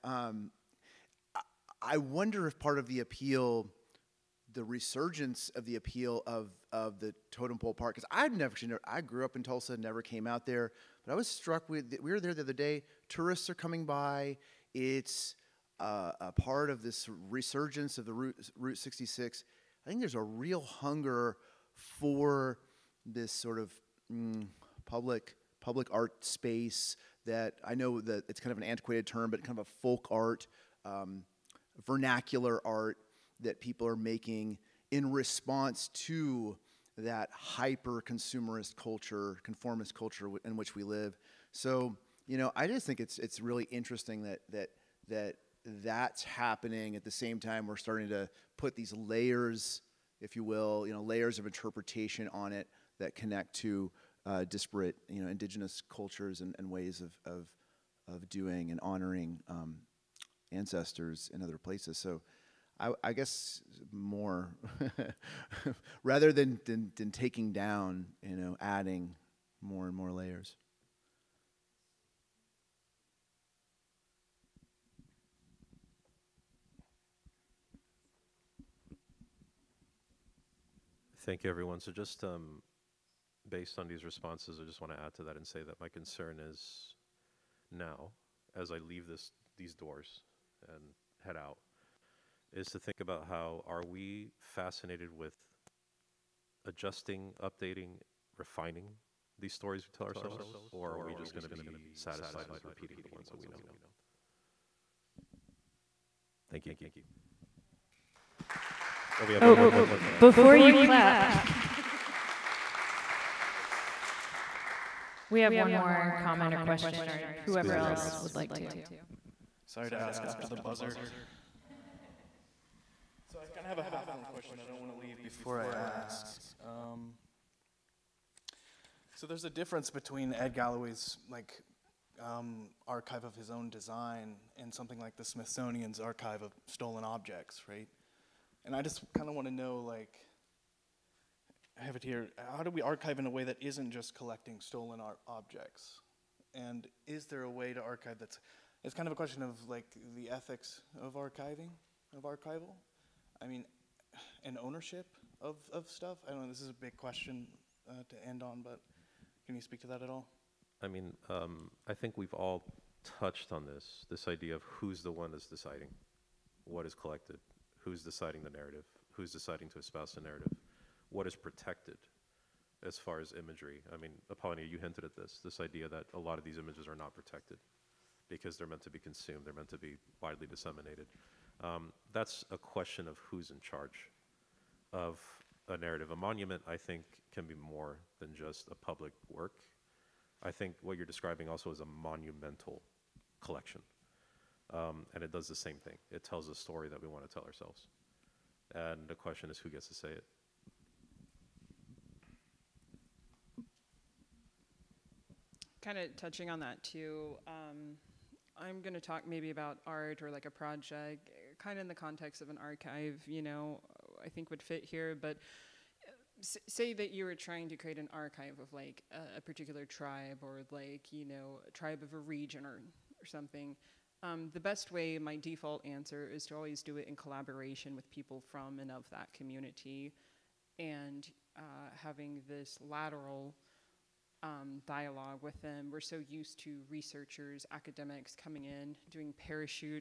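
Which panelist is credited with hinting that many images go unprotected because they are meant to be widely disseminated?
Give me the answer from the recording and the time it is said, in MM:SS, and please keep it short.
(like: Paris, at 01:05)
Apollonia, at 02:54.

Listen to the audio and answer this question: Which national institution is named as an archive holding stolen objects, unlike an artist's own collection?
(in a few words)
Smithsonian.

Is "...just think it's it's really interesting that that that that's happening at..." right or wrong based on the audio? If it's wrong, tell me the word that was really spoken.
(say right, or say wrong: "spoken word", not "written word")
right.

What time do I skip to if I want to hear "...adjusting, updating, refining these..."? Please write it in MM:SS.
01:36.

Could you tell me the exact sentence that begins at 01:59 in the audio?
Sorry to ask after the buzzer.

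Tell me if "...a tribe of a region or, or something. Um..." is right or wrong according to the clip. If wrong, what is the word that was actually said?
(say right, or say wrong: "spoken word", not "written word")
right.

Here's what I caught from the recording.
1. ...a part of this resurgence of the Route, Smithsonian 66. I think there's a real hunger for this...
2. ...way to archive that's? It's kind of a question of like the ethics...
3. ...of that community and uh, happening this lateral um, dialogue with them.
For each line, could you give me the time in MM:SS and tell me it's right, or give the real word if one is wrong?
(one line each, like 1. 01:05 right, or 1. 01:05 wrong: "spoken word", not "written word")
1. 00:16 wrong: "Route", not "Smithsonian"
2. 02:27 right
3. 03:48 wrong: "having", not "happening".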